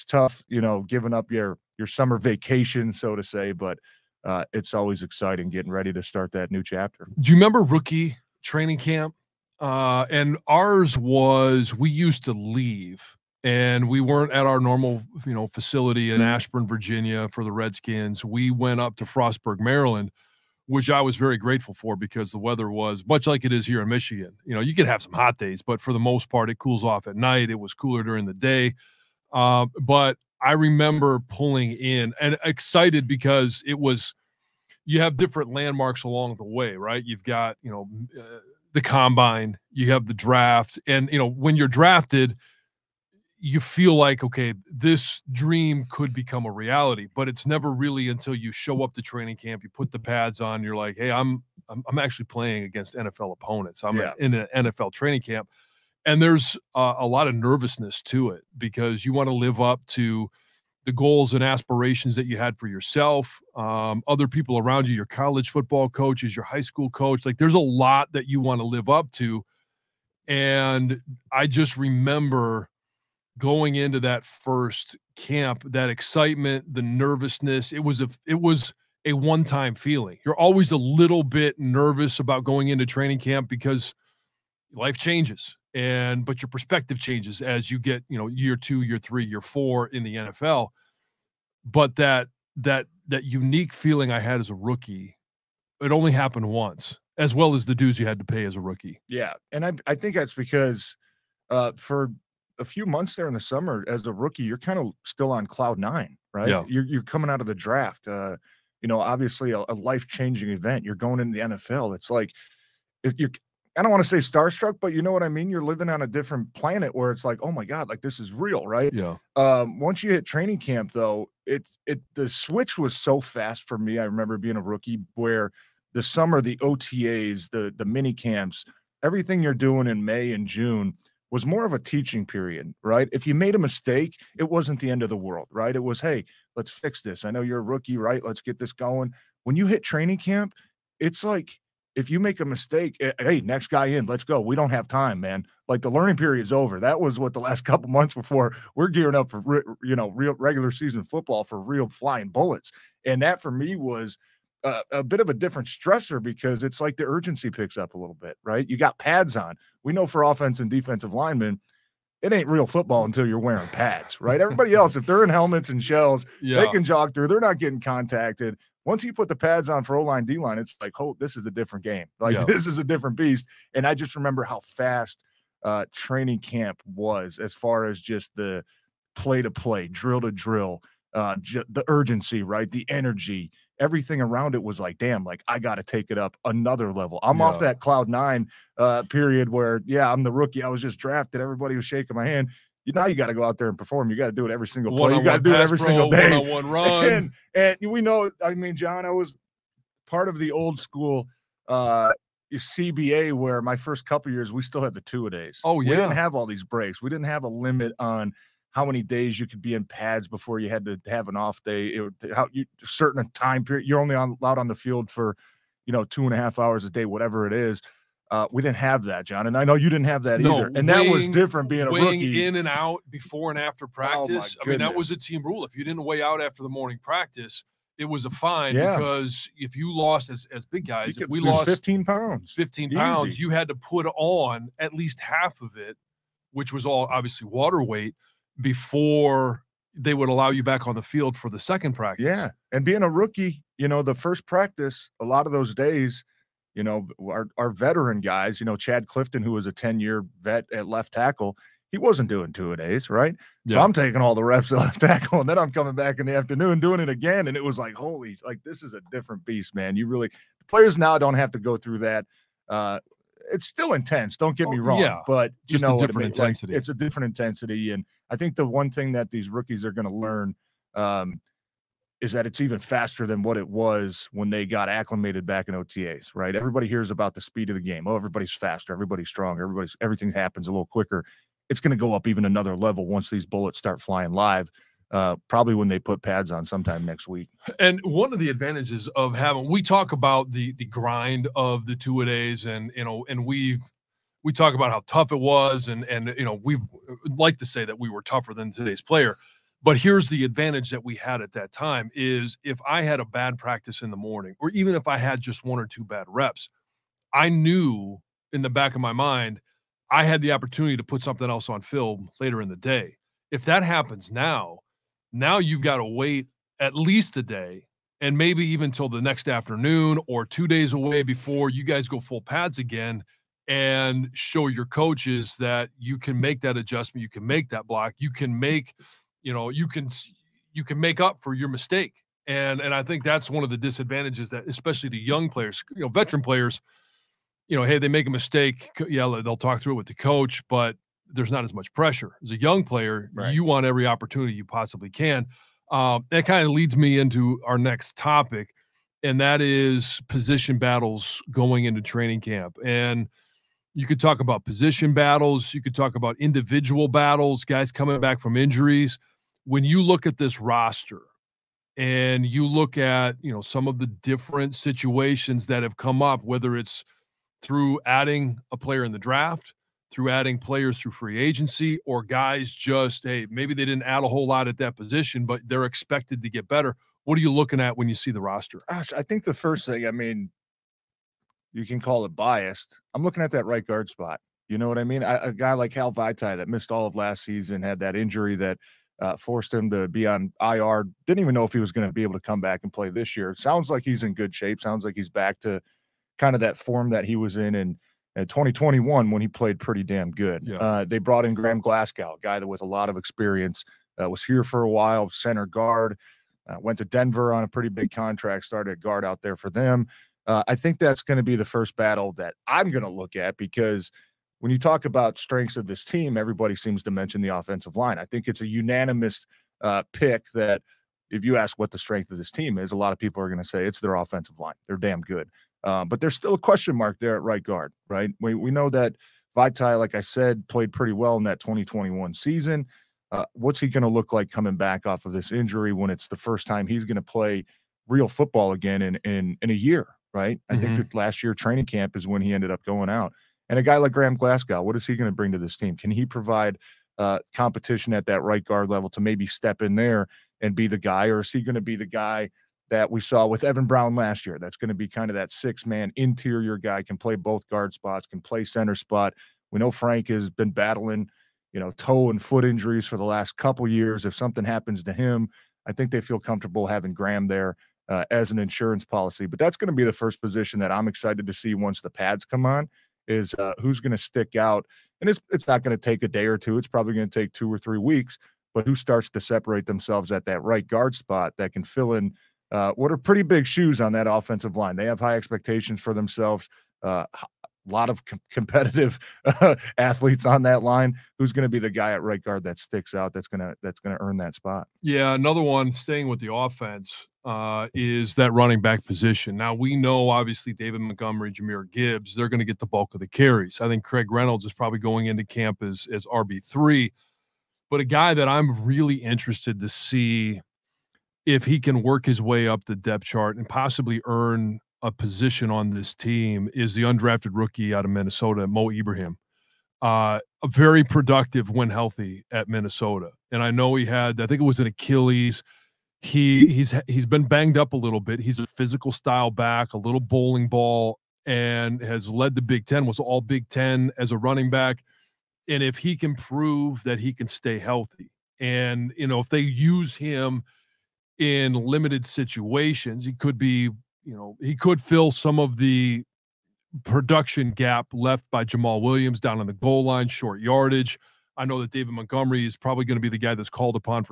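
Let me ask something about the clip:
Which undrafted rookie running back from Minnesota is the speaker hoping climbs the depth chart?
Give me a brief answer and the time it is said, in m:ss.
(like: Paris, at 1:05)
Mo Ibrahim, at 8:38.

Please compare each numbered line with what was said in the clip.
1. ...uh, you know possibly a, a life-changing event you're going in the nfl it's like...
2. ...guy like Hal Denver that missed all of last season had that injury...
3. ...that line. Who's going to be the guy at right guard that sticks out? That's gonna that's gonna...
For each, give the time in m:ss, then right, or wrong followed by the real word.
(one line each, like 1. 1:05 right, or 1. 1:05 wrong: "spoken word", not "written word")
1. 1:48 wrong: "obviously", not "possibly"
2. 6:25 wrong: "Vaitai", not "Denver"
3. 8:10 right.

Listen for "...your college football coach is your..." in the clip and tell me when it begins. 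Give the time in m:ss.
1:04.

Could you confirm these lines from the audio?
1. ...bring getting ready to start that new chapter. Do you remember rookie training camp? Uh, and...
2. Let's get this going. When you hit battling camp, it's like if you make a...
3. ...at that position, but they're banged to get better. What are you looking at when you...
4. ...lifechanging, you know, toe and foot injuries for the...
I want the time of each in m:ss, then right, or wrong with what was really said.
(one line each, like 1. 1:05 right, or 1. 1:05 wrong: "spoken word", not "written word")
1. 0:05 wrong: "exciting", not "bring"
2. 2:18 wrong: "training", not "battling"
3. 6:14 wrong: "expected", not "banged"
4. 7:40 wrong: "battling", not "lifechanging".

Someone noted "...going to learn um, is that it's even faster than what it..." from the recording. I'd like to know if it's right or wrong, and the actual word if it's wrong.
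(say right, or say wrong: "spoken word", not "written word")
right.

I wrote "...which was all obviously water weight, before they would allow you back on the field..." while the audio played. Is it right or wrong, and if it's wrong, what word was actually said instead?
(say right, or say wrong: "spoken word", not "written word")
right.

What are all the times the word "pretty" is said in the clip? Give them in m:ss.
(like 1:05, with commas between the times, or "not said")
6:39, 6:47, 7:10, 8:03.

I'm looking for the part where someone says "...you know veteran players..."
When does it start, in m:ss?
5:35.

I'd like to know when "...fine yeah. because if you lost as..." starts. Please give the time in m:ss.
3:48.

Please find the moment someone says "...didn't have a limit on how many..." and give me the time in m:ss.
3:27.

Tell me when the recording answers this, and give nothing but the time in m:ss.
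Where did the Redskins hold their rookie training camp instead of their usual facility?
0:19.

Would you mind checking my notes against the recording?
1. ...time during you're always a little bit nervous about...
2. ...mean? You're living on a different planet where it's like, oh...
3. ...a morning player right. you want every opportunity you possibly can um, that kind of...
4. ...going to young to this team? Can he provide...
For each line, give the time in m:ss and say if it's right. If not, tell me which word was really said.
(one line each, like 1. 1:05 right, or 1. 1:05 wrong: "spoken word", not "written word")
1. 1:19 wrong: "feeling", not "during"
2. 1:55 right
3. 5:42 wrong: "young", not "morning"
4. 7:25 wrong: "bring", not "young".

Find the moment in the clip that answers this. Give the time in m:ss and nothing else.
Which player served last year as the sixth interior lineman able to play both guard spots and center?
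7:33.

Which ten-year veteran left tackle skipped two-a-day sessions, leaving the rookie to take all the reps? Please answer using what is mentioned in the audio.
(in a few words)
Chad Clifton.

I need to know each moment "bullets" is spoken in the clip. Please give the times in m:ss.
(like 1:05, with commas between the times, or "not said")
2:32, 4:43.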